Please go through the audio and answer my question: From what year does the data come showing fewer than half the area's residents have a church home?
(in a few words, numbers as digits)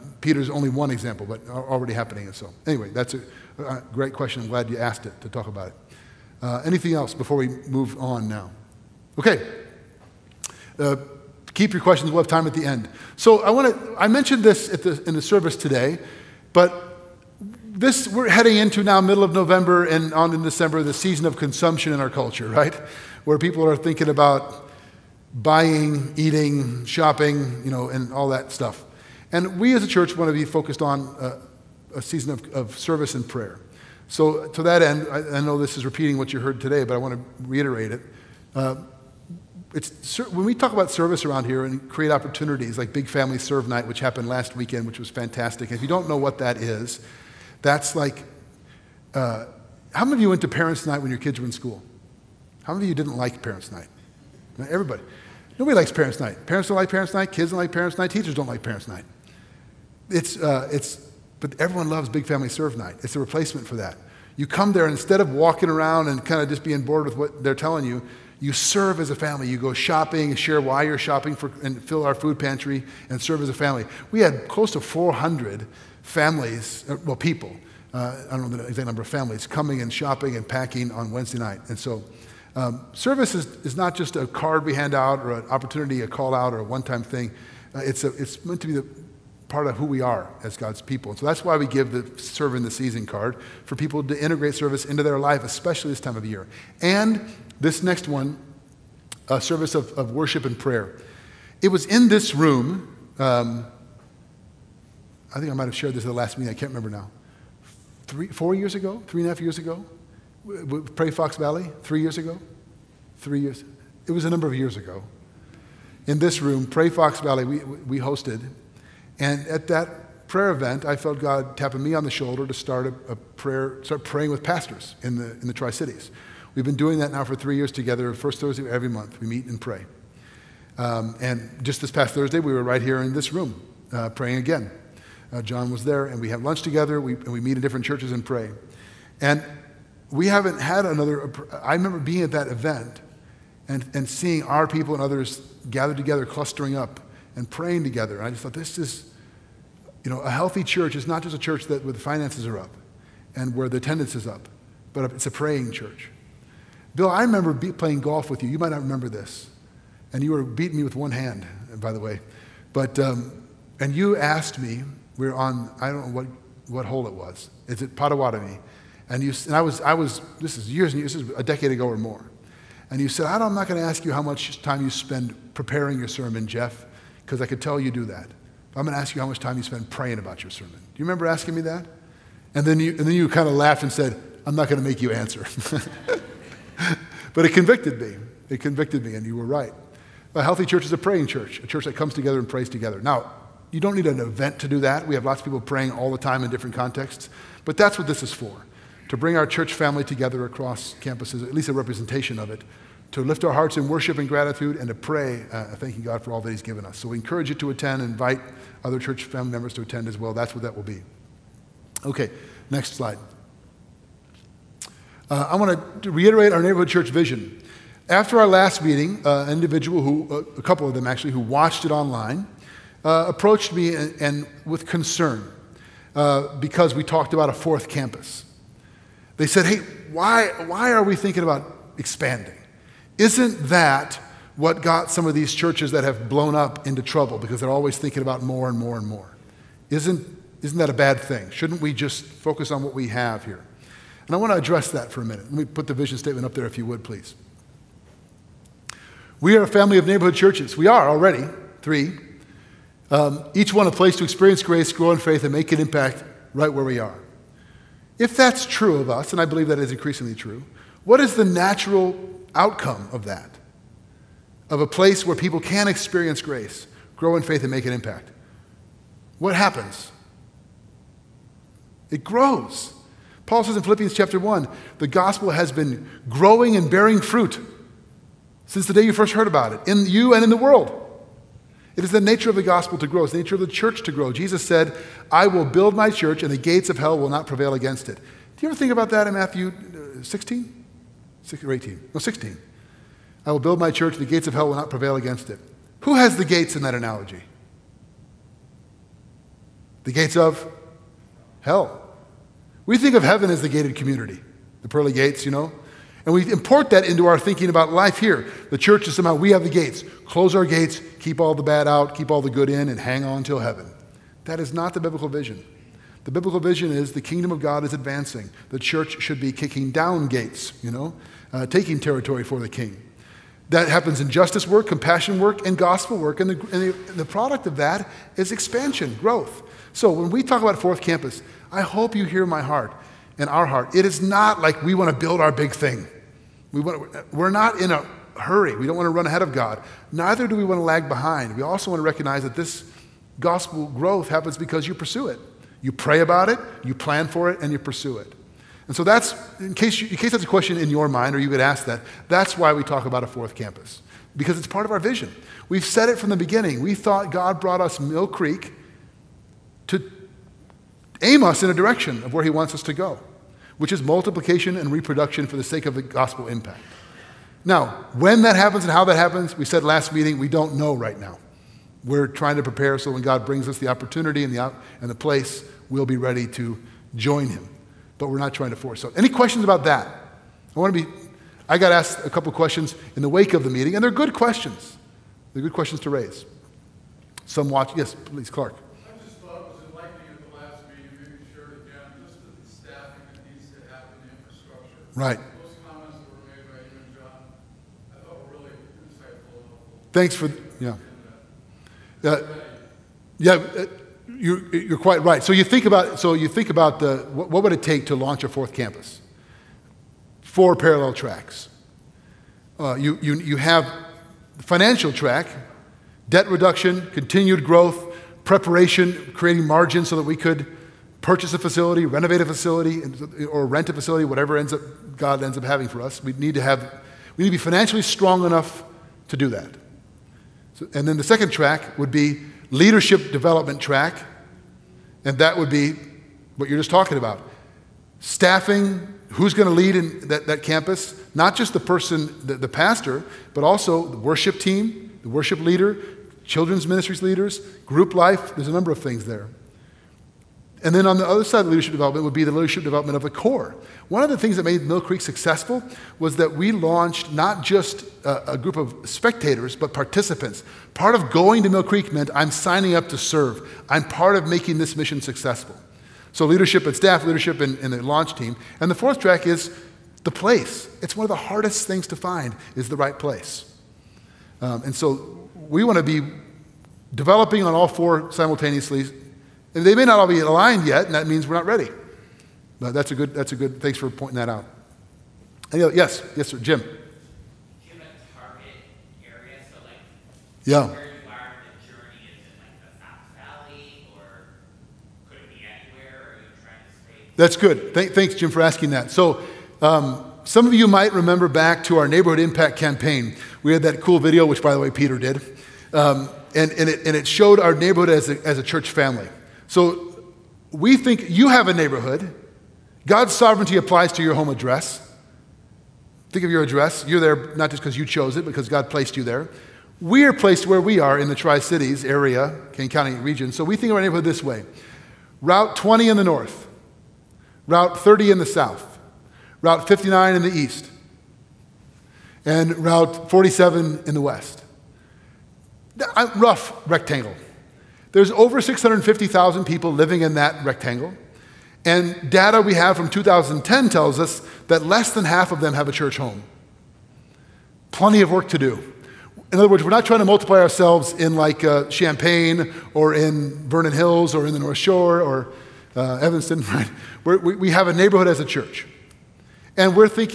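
2010.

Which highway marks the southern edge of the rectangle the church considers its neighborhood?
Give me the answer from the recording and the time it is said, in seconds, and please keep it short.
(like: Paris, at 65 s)
Route 30, at 527 s.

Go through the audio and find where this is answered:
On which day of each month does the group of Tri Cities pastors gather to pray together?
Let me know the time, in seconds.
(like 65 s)
128 s.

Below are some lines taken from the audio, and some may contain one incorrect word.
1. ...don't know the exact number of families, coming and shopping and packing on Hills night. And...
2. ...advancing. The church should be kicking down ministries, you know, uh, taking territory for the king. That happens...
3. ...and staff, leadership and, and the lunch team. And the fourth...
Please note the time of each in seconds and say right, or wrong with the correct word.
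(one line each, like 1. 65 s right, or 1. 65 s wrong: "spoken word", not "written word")
1. 78 s wrong: "Wednesday", not "Hills"
2. 317 s wrong: "gates", not "ministries"
3. 466 s wrong: "launch", not "lunch".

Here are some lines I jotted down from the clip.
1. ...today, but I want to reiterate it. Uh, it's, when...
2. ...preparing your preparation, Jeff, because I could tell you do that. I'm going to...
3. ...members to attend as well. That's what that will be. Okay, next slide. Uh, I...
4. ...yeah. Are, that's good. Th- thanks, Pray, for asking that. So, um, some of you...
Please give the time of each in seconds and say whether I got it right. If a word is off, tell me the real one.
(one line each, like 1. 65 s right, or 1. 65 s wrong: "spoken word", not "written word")
1. 36 s right
2. 175 s wrong: "sermon", not "preparation"
3. 209 s right
4. 490 s wrong: "Jim", not "Pray".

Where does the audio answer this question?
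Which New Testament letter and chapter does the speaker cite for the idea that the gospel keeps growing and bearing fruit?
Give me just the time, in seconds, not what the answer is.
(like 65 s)
273 s.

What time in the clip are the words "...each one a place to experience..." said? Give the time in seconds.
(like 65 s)
253 s.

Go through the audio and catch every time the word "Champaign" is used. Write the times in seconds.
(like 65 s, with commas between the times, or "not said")
551 s.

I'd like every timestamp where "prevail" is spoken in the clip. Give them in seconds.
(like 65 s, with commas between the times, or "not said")
287 s, 294 s.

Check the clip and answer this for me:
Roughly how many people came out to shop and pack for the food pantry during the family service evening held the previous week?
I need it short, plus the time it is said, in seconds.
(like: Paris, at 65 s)
400, at 74 s.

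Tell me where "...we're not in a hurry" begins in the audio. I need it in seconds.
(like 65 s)
337 s.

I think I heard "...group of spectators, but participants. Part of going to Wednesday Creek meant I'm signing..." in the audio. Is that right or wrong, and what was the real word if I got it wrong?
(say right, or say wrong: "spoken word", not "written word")
wrong: "Mill", not "Wednesday".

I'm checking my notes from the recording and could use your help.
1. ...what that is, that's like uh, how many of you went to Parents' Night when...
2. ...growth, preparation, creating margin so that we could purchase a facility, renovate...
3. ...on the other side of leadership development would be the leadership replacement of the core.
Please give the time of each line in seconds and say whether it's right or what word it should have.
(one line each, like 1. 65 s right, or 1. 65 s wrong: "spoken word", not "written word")
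1. 46 s right
2. 417 s right
3. 451 s wrong: "development", not "replacement".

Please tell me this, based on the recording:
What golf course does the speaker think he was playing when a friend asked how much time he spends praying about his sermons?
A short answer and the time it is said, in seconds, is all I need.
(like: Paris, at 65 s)
Pottawatomie, at 167 s.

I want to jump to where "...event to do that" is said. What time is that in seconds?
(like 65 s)
194 s.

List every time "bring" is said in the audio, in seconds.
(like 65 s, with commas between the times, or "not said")
199 s, 373 s.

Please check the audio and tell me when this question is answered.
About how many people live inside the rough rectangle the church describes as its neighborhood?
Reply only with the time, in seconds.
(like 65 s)
538 s.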